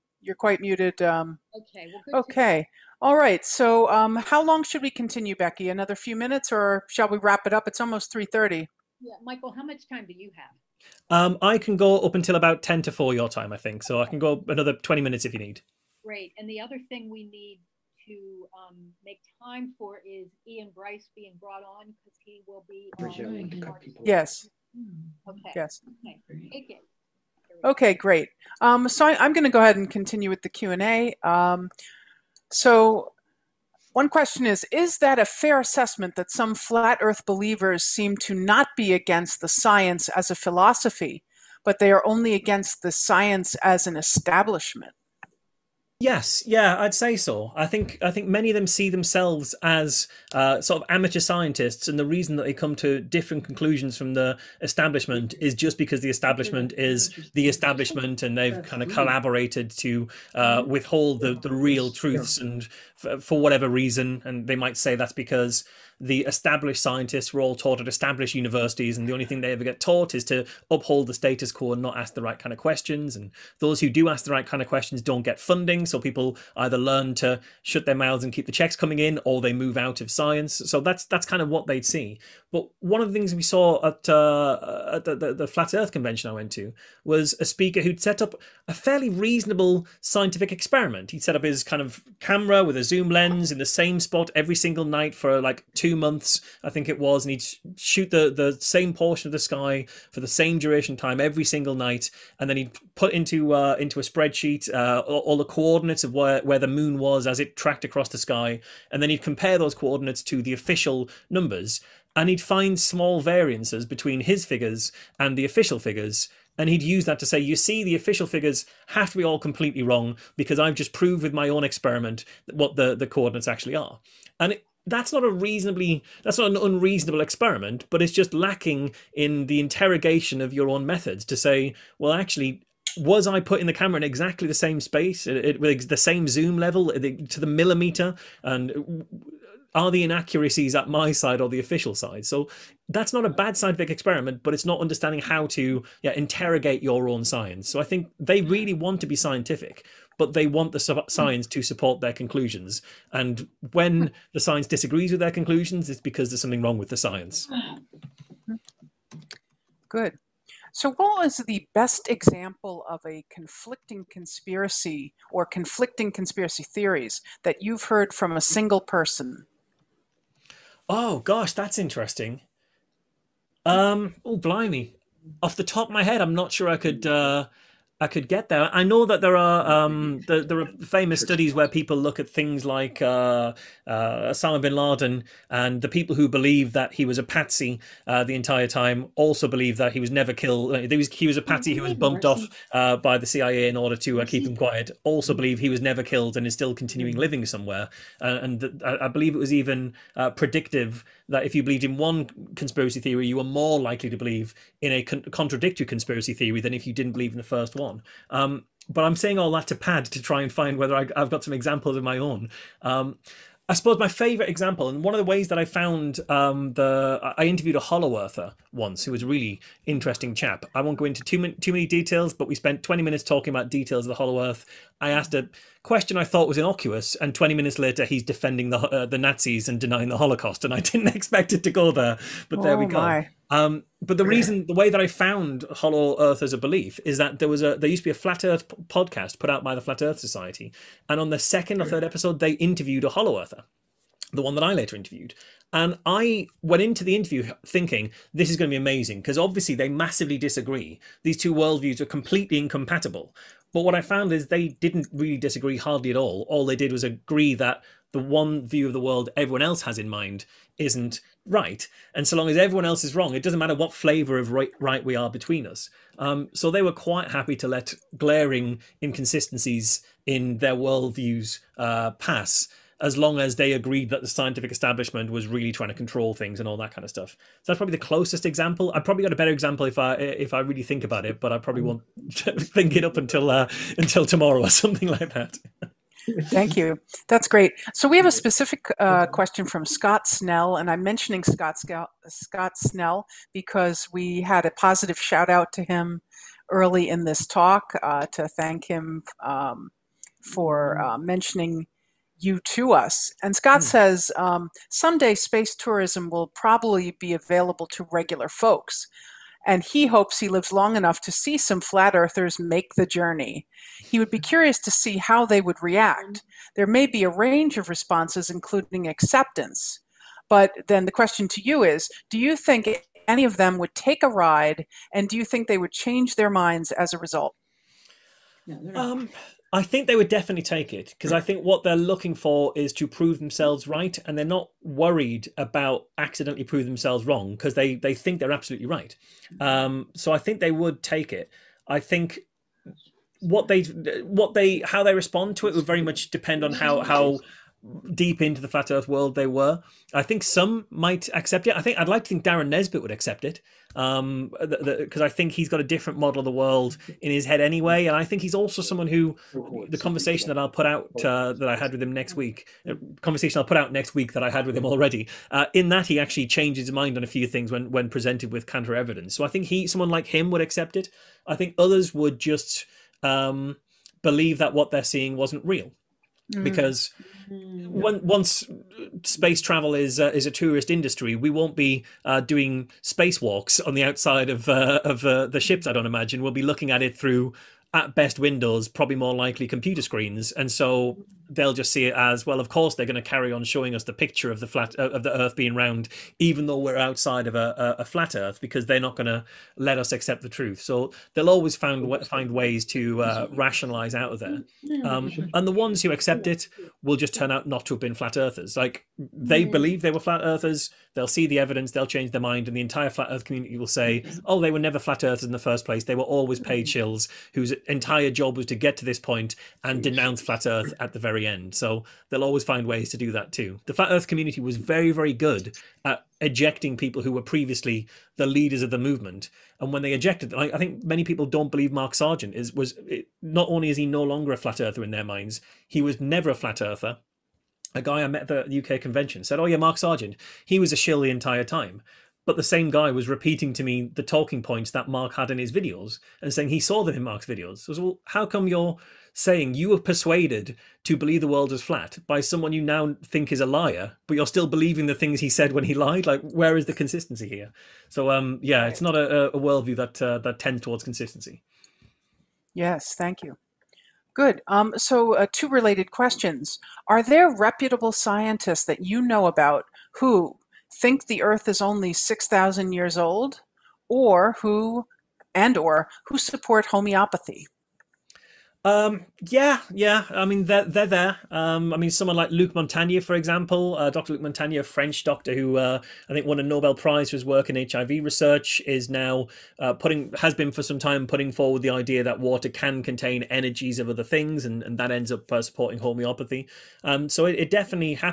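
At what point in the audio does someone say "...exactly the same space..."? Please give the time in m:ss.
2:14.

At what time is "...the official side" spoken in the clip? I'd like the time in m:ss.
2:21.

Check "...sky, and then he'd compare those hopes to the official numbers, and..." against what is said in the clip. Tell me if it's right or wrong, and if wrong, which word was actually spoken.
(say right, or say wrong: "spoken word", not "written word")
wrong: "coordinates", not "hopes".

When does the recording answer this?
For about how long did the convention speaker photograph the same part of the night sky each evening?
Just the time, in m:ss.
1:35.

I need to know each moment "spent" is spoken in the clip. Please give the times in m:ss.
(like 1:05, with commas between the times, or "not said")
3:42.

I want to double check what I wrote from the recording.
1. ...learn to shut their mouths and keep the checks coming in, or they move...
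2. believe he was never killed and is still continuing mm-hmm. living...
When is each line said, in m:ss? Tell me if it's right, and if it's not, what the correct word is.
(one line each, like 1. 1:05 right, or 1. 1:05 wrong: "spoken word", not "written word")
1. 1:16 right
2. 3:15 right.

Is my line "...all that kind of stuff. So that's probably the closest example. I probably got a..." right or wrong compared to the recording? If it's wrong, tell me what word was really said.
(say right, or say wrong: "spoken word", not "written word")
right.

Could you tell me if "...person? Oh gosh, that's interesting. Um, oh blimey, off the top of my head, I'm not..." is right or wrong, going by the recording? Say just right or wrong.
right.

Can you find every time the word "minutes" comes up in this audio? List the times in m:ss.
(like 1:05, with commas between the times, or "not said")
0:06, 0:15, 3:43, 3:47.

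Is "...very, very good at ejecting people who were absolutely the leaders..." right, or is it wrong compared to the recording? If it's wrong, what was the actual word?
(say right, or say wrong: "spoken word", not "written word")
wrong: "previously", not "absolutely".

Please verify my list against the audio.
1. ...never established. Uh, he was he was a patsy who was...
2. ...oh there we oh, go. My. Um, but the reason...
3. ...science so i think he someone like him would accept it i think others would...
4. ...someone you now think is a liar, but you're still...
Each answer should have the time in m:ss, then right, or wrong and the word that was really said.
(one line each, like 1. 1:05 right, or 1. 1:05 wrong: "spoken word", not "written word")
1. 3:10 wrong: "killed", not "established"
2. 3:52 right
3. 6:08 wrong: "evidence", not "science"
4. 7:32 right.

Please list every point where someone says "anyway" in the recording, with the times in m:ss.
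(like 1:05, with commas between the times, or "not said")
5:57.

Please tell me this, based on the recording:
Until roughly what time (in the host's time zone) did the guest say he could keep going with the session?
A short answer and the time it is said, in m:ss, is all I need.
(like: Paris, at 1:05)
ten to four, at 0:12.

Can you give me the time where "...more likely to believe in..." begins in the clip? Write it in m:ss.
3:23.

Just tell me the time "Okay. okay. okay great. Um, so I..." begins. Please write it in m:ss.
0:26.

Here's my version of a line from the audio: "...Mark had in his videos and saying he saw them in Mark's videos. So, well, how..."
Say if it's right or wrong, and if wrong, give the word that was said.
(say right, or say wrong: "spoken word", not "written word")
right.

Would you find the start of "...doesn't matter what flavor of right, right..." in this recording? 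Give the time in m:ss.
4:23.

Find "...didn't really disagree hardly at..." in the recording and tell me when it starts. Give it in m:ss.
4:14.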